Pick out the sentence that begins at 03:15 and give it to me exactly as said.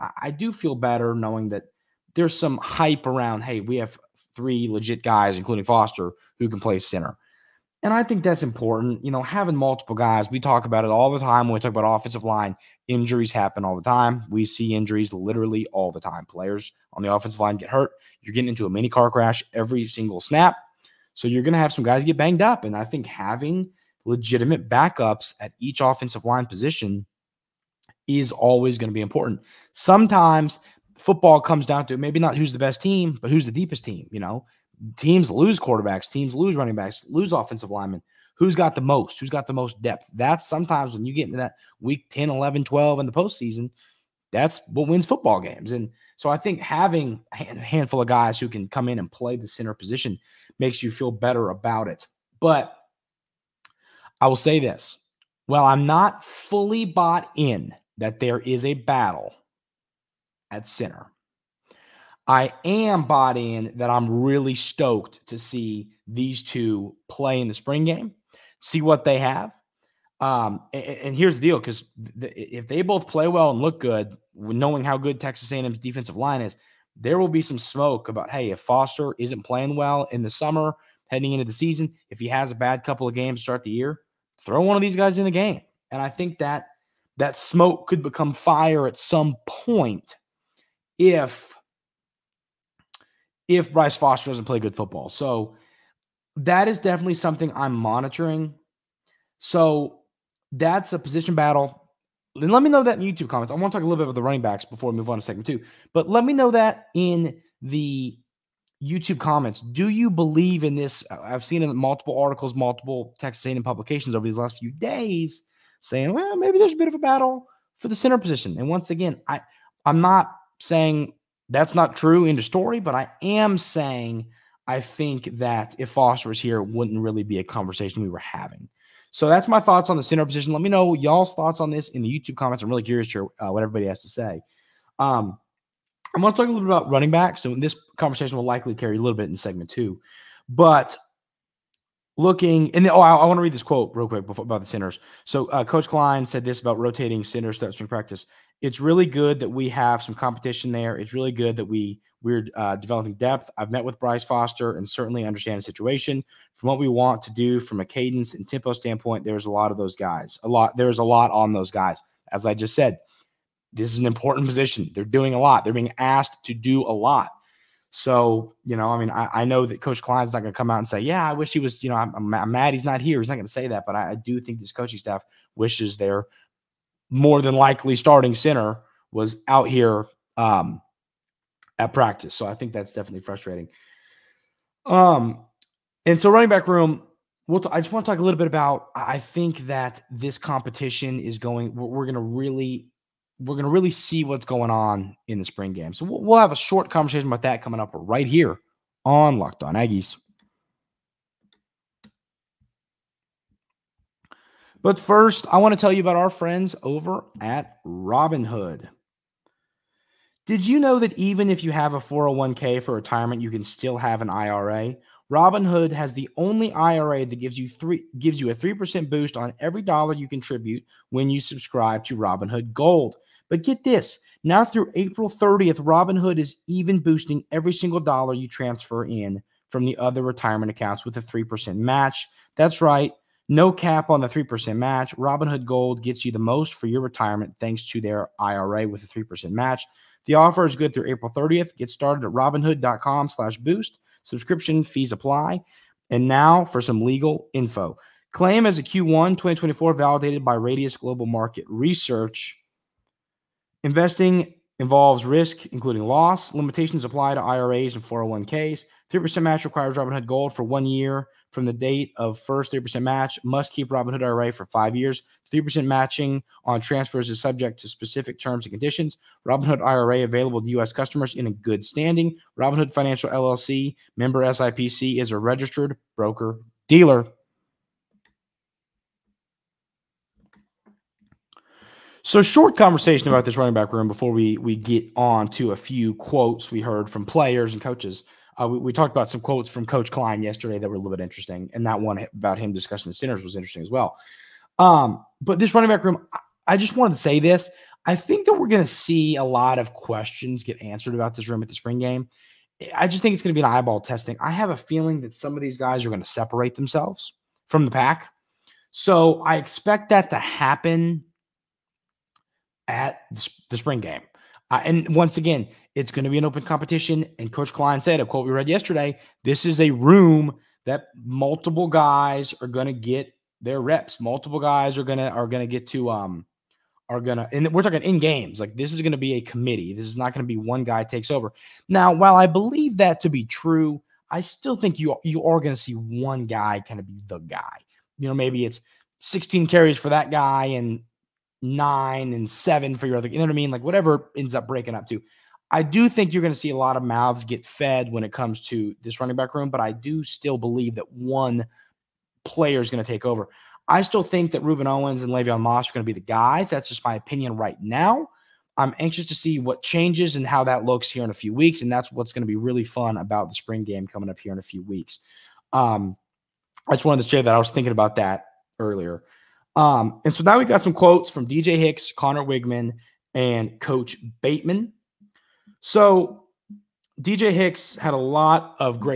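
So we'll, we'll have a short conversation about that coming up right here on Locked On Aggies.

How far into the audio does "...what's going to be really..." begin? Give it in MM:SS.
06:02.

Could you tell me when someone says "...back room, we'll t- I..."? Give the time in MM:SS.
03:06.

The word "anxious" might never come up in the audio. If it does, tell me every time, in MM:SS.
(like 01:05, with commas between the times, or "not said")
05:58.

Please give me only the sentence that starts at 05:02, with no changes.
I just think it's going to be an eyeball testing.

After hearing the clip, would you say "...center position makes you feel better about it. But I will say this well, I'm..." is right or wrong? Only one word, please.
right.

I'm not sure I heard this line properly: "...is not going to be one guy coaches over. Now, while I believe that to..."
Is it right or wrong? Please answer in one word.
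wrong.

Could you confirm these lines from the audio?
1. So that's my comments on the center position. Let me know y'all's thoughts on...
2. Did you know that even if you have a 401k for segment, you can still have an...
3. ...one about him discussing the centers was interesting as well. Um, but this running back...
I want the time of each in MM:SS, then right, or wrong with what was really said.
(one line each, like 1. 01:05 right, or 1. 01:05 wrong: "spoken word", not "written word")
1. 02:09 wrong: "thoughts", not "comments"
2. 03:30 wrong: "retirement", not "segment"
3. 04:51 right.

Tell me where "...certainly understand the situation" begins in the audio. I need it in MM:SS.
02:34.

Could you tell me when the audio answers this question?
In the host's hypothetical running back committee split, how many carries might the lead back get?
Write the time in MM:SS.
05:39.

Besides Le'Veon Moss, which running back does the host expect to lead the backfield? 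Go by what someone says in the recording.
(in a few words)
Rueben Owens.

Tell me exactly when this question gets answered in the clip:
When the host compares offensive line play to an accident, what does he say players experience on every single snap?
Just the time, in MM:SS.
00:18.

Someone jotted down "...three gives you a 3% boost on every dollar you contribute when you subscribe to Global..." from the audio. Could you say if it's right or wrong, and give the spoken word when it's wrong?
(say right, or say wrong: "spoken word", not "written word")
wrong: "Robinhood", not "Global".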